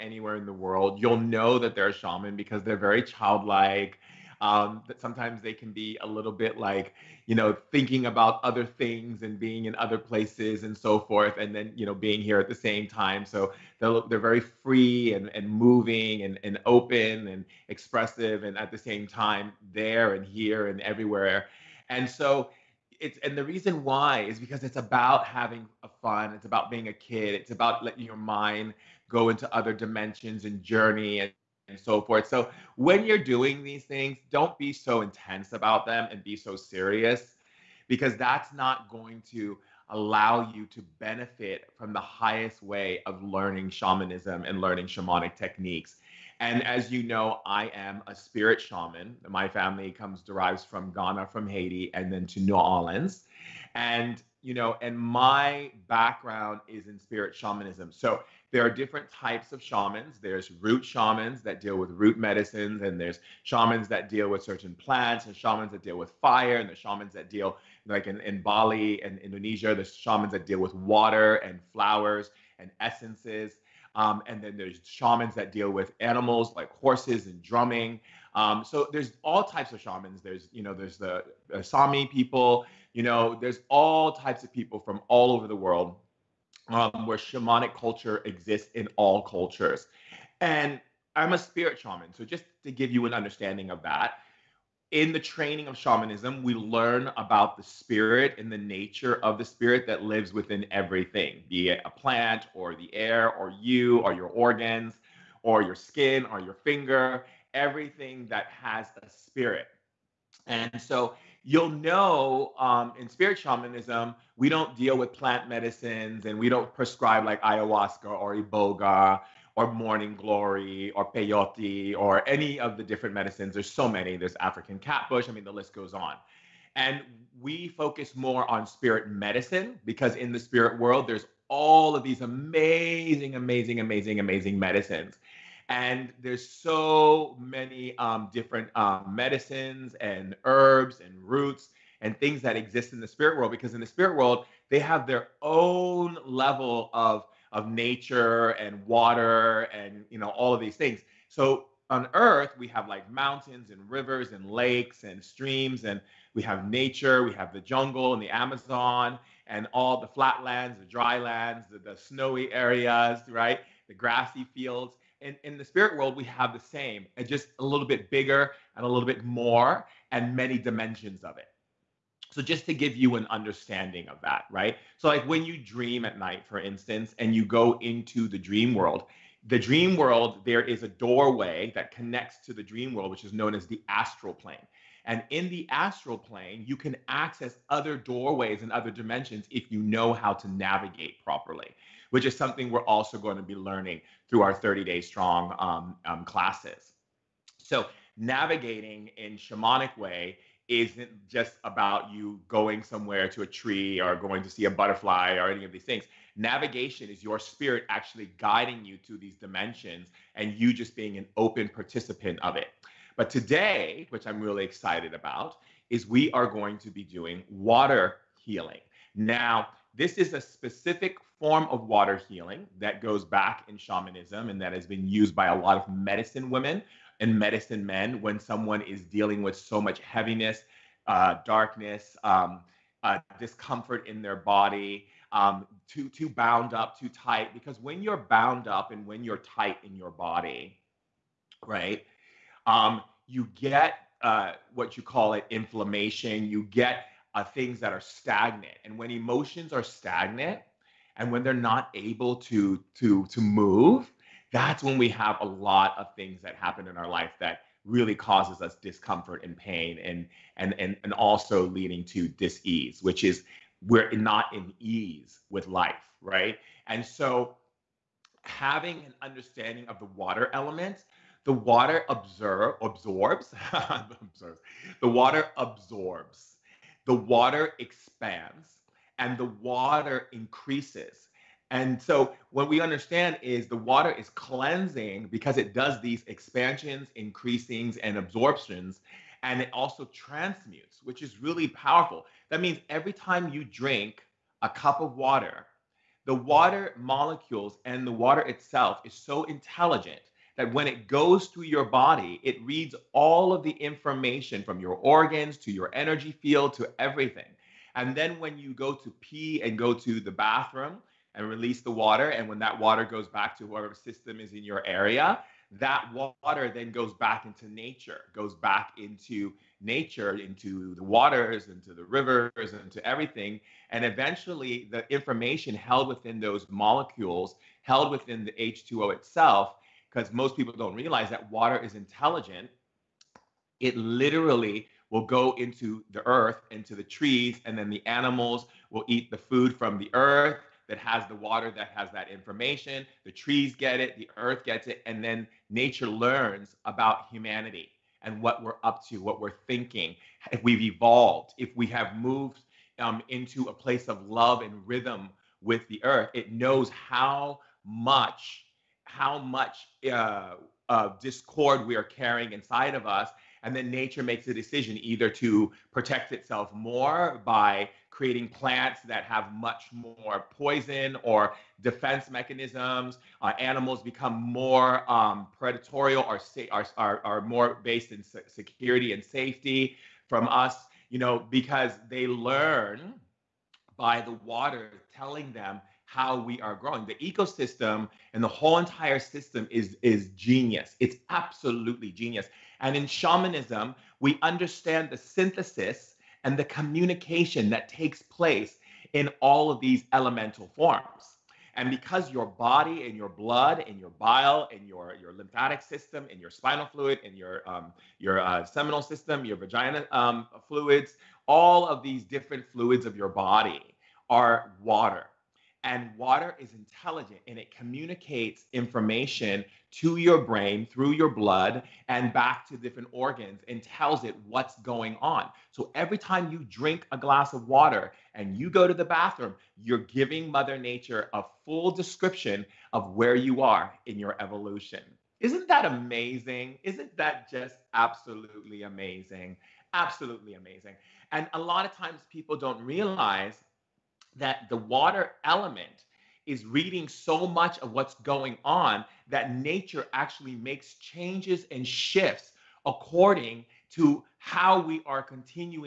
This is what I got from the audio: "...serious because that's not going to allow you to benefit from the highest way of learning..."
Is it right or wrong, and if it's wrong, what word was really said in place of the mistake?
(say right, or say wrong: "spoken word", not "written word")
right.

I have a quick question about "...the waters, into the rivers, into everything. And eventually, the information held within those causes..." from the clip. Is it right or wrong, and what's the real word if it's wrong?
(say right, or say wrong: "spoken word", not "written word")
wrong: "molecules", not "causes".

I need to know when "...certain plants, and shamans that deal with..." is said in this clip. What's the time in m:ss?
1:04.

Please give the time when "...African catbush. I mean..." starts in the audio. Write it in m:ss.
2:04.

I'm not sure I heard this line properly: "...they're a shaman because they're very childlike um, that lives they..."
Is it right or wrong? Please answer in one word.
wrong.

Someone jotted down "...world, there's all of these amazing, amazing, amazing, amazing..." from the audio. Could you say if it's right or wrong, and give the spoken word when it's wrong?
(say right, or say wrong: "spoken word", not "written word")
right.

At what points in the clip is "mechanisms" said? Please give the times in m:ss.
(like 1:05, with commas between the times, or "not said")
6:12.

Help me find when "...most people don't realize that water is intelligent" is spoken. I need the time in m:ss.
5:30.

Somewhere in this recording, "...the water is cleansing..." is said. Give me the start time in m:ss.
4:43.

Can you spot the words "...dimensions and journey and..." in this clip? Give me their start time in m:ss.
0:29.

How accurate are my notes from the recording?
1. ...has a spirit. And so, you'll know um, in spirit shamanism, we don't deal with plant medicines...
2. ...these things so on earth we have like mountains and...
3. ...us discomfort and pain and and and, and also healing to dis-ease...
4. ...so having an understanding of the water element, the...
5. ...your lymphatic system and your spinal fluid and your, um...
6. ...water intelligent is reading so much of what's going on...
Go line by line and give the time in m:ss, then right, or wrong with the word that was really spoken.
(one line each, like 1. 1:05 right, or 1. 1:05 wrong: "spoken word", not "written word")
1. 1:48 right
2. 2:30 right
3. 4:18 wrong: "leading", not "healing"
4. 4:27 right
5. 6:45 right
6. 7:24 wrong: "element", not "intelligent".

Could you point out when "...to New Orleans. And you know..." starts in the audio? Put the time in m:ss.
0:52.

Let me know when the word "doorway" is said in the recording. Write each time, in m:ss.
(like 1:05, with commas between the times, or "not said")
3:00, 3:07.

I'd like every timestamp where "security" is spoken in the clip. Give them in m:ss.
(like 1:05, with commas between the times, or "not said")
6:18.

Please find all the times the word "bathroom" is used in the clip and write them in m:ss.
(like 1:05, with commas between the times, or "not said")
5:10, 7:09.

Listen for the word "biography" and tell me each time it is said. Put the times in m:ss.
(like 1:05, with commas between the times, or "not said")
not said.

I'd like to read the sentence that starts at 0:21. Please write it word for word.
And so it's and the reason why is because it's about having a fun.